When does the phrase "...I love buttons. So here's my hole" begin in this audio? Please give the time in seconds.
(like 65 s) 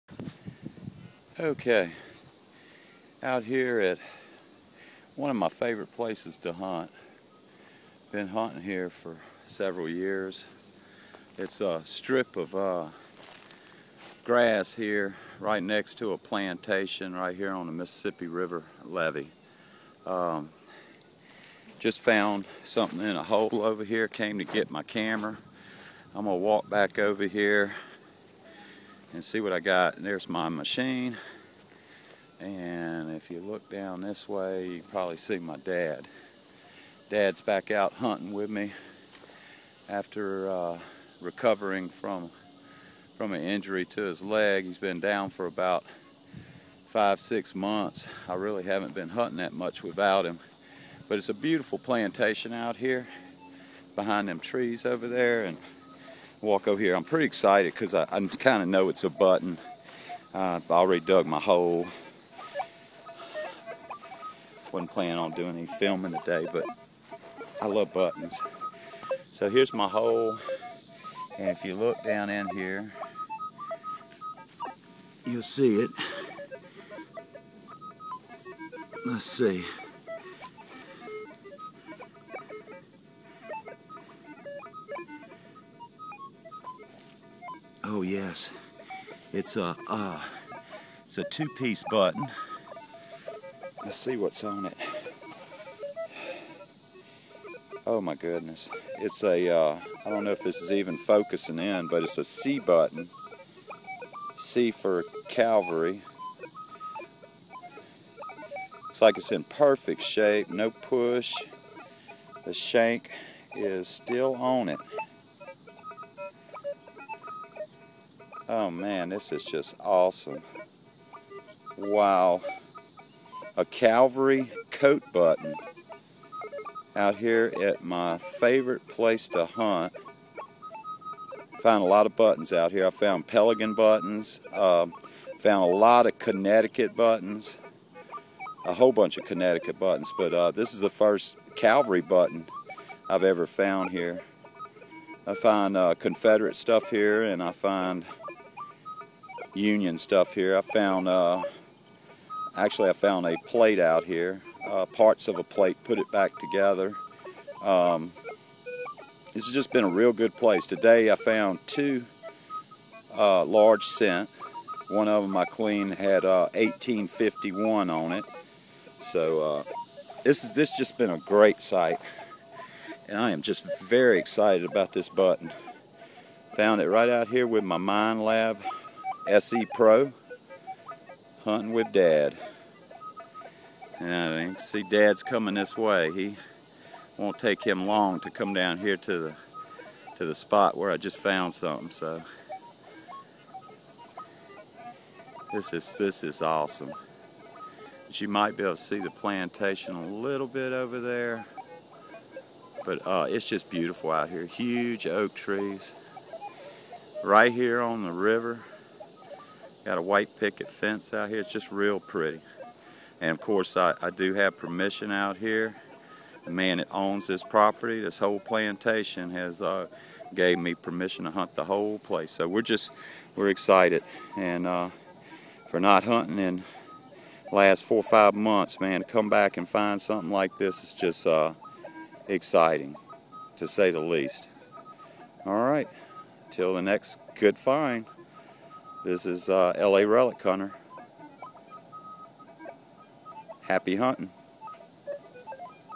67 s.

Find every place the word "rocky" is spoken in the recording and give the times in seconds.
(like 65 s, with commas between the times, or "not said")
not said.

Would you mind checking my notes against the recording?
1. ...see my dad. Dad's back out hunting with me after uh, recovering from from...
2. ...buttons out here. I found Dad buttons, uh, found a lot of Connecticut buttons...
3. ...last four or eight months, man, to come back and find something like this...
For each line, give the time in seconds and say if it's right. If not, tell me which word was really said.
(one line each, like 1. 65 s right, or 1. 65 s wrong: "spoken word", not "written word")
1. 35 s right
2. 132 s wrong: "Pelican", not "Dad"
3. 227 s wrong: "five", not "eight".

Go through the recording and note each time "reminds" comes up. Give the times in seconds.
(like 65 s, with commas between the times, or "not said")
not said.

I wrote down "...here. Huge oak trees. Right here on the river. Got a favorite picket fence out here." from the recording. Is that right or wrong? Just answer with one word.
wrong.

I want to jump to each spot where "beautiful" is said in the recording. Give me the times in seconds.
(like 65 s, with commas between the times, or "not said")
51 s, 203 s.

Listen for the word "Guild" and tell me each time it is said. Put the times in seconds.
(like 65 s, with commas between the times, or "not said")
not said.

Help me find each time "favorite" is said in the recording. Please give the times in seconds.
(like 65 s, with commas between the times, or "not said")
5 s, 128 s.